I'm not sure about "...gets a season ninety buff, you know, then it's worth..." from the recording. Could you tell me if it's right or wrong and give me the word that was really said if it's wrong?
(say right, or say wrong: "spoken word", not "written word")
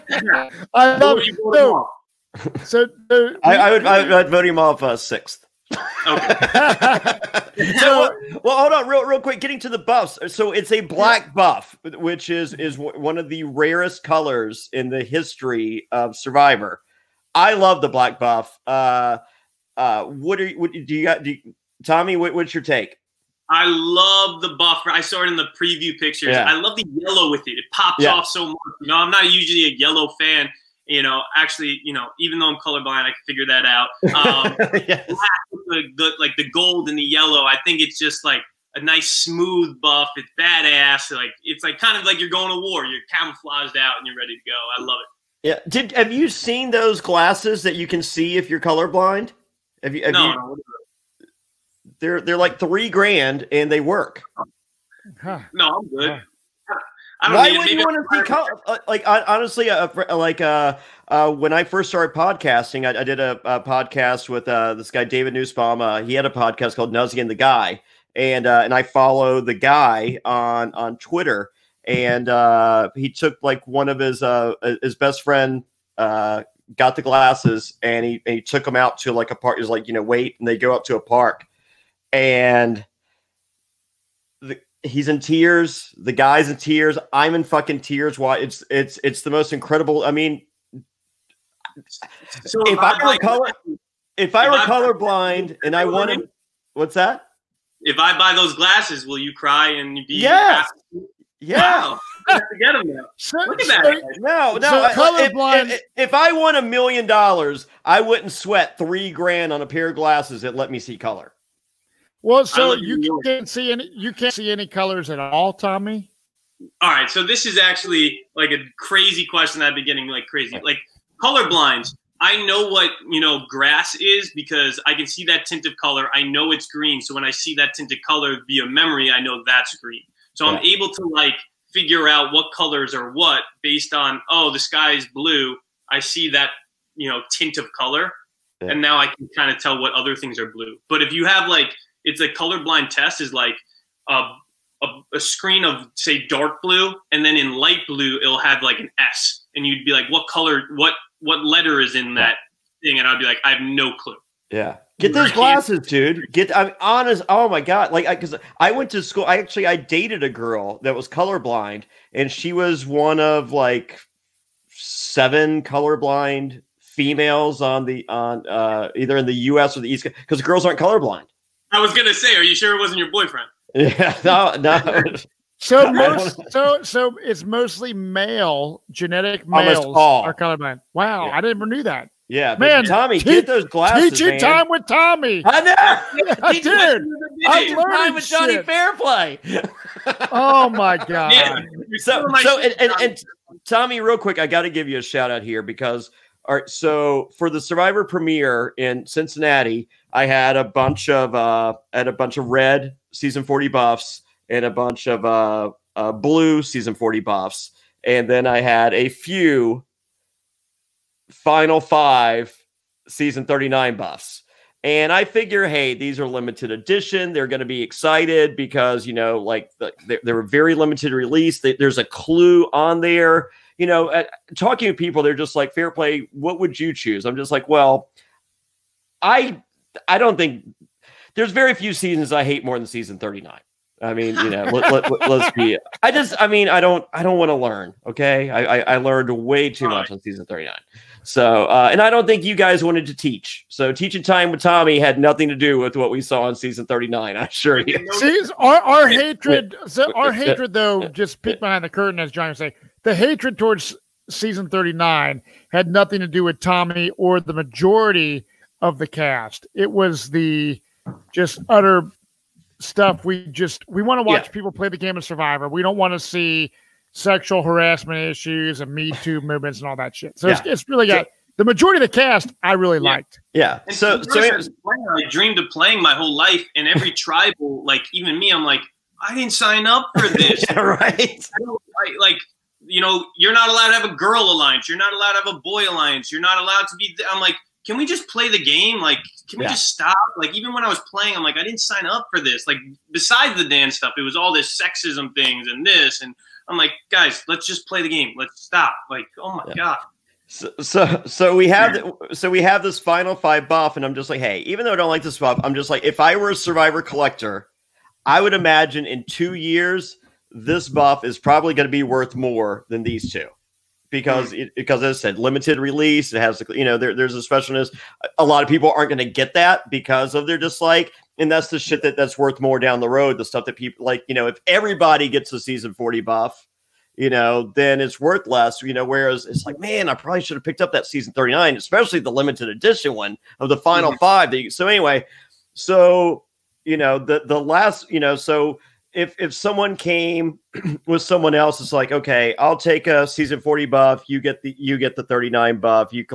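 wrong: "forty", not "ninety".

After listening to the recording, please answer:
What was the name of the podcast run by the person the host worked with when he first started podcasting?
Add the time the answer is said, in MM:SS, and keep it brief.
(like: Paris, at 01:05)
Nuzzy and the Guy, at 01:06.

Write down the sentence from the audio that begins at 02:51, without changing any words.
I was gonna say, are you sure it wasn't your boyfriend?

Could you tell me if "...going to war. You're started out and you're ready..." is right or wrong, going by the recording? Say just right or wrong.
wrong.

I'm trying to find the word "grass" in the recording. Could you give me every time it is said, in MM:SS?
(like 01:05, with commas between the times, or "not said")
02:03.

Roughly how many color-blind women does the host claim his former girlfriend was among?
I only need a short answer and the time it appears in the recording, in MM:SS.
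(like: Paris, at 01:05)
7, at 02:44.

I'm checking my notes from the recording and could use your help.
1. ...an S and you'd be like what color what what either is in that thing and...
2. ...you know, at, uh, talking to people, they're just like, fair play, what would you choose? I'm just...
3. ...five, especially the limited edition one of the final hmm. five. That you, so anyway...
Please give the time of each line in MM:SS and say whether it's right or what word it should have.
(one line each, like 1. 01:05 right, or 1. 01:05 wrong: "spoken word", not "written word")
1. 02:28 wrong: "letter", not "either"
2. 03:43 right
3. 05:31 wrong: "nine", not "five".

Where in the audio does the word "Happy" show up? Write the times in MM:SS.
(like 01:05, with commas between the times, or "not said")
01:40.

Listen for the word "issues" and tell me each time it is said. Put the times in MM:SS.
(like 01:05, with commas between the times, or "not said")
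04:28.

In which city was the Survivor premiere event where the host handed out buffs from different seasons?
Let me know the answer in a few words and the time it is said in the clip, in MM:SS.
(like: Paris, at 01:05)
Cincinnati, at 03:19.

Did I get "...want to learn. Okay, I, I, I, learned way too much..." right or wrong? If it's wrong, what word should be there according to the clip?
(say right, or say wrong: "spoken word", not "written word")
right.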